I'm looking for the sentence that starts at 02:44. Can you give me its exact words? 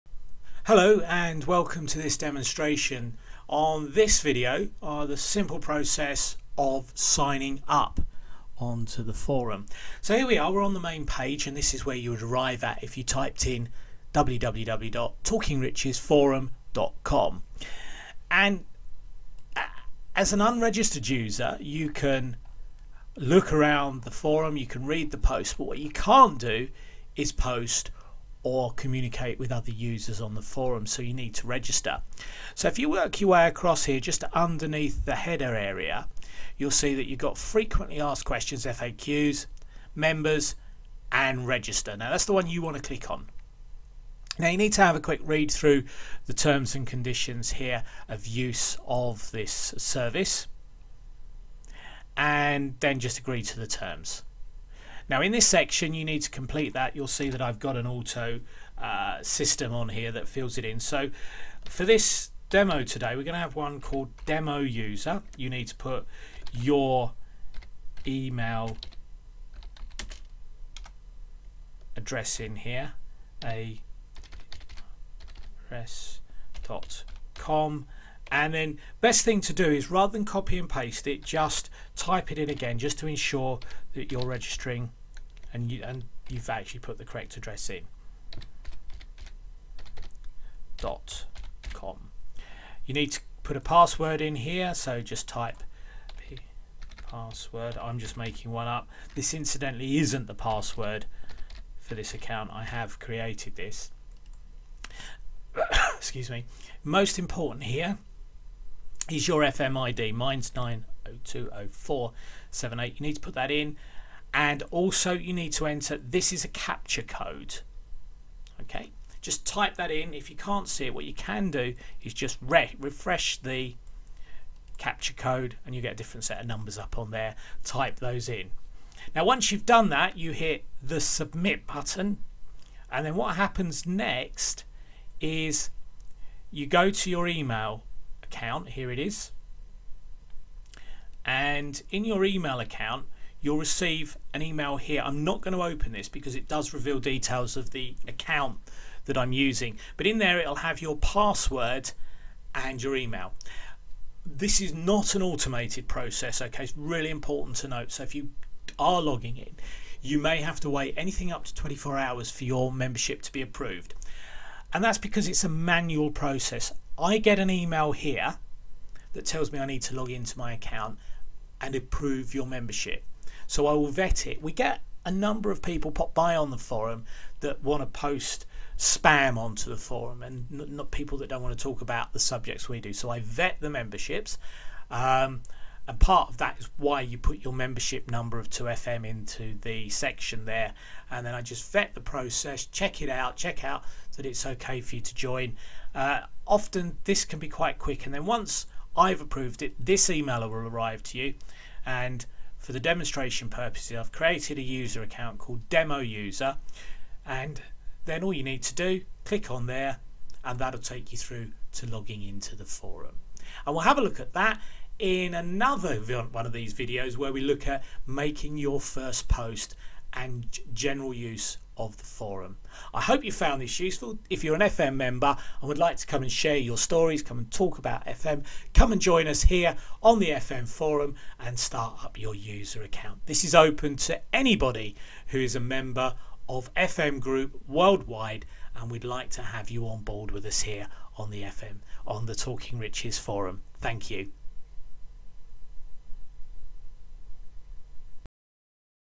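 And that's because it's a manual process.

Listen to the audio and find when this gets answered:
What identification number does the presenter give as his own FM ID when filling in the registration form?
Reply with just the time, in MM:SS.
01:50.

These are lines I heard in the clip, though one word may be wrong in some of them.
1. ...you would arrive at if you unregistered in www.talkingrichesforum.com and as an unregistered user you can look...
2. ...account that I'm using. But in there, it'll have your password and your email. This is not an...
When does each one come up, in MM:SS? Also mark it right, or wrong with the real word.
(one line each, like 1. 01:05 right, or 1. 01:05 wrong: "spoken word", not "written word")
1. 00:11 wrong: "typed", not "unregistered"
2. 02:28 right.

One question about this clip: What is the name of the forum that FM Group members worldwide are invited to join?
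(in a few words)
Talking Riches forum.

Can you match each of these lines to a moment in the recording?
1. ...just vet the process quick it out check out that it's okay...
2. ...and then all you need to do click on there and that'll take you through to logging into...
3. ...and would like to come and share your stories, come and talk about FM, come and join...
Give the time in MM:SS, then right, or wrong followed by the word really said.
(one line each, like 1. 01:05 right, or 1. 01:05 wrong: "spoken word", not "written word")
1. 03:11 wrong: "check", not "quick"
2. 03:27 right
3. 03:45 right.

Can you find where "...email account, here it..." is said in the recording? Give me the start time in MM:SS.
02:17.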